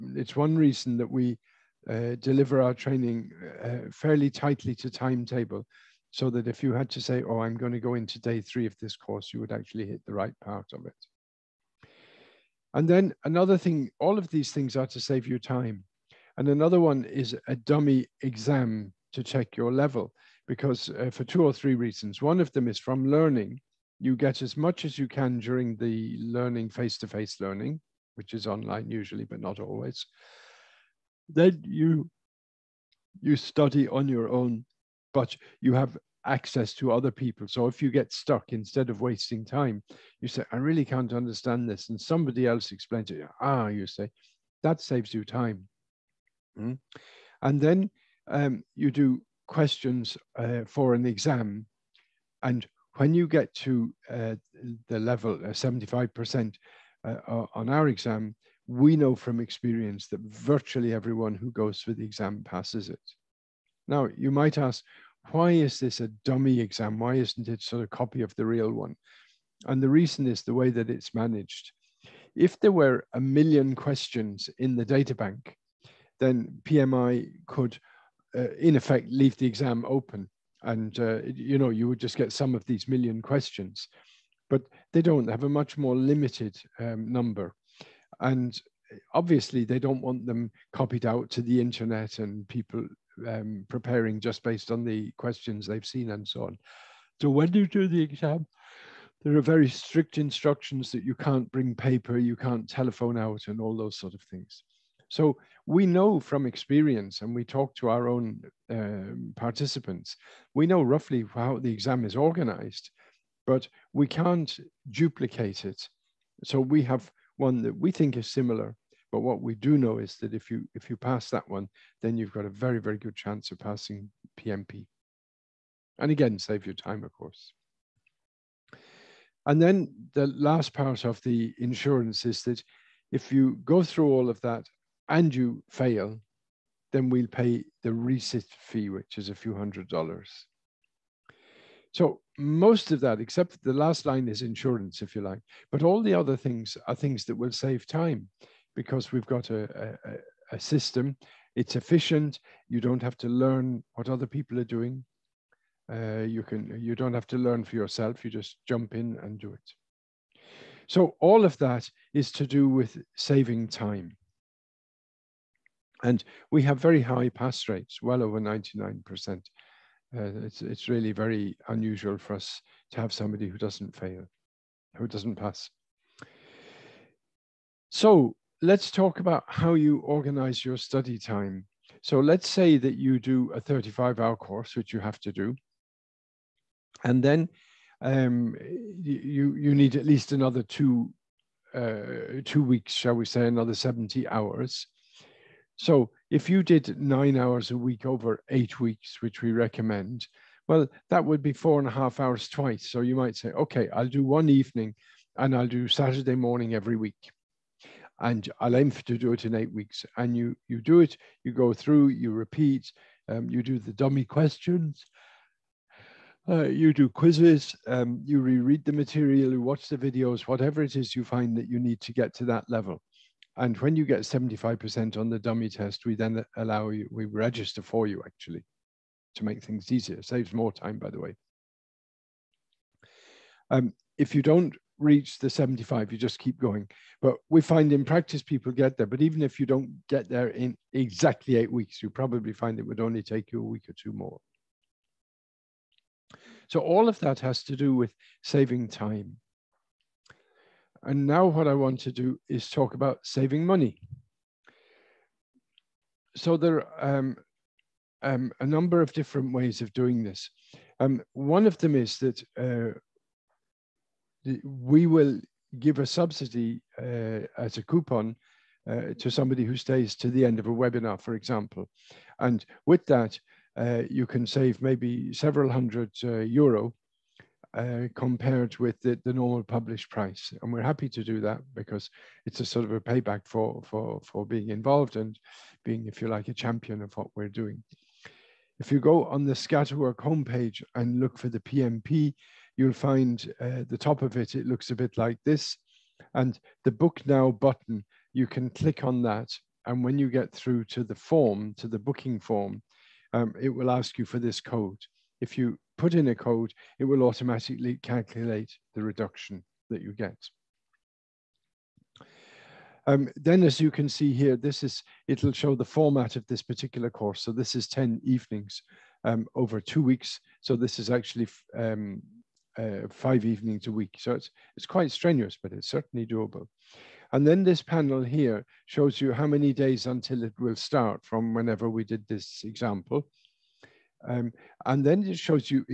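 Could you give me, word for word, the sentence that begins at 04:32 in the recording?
And with that, uh, you can save maybe several hundred uh, euro uh, compared with the, the, normal published price.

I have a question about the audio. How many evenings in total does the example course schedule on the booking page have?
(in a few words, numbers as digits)
10.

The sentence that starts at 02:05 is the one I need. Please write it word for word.
And again, save your time, of course.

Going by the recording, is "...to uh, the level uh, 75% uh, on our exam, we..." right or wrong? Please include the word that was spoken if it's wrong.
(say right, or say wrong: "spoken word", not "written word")
right.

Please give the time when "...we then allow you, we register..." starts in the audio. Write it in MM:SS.
03:46.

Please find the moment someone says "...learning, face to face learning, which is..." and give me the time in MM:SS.
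00:26.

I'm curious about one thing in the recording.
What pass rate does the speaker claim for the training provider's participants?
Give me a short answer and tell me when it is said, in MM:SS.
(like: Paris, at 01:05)
over 99%, at 02:48.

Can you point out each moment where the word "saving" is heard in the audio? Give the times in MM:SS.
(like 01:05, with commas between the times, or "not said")
02:43, 04:08, 04:13.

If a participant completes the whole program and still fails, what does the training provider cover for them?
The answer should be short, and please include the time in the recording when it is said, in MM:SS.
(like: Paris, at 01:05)
the resit fee, at 02:17.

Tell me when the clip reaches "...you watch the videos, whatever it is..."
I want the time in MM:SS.
03:39.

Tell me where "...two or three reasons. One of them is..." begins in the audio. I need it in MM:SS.
00:21.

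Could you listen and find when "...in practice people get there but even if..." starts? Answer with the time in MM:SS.
03:57.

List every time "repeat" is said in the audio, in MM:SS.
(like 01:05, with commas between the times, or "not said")
03:32.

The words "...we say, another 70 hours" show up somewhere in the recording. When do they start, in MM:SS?
03:13.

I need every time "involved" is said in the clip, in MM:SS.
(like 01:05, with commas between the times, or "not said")
04:44.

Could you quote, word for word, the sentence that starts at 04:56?
And the book now button, you can click on that.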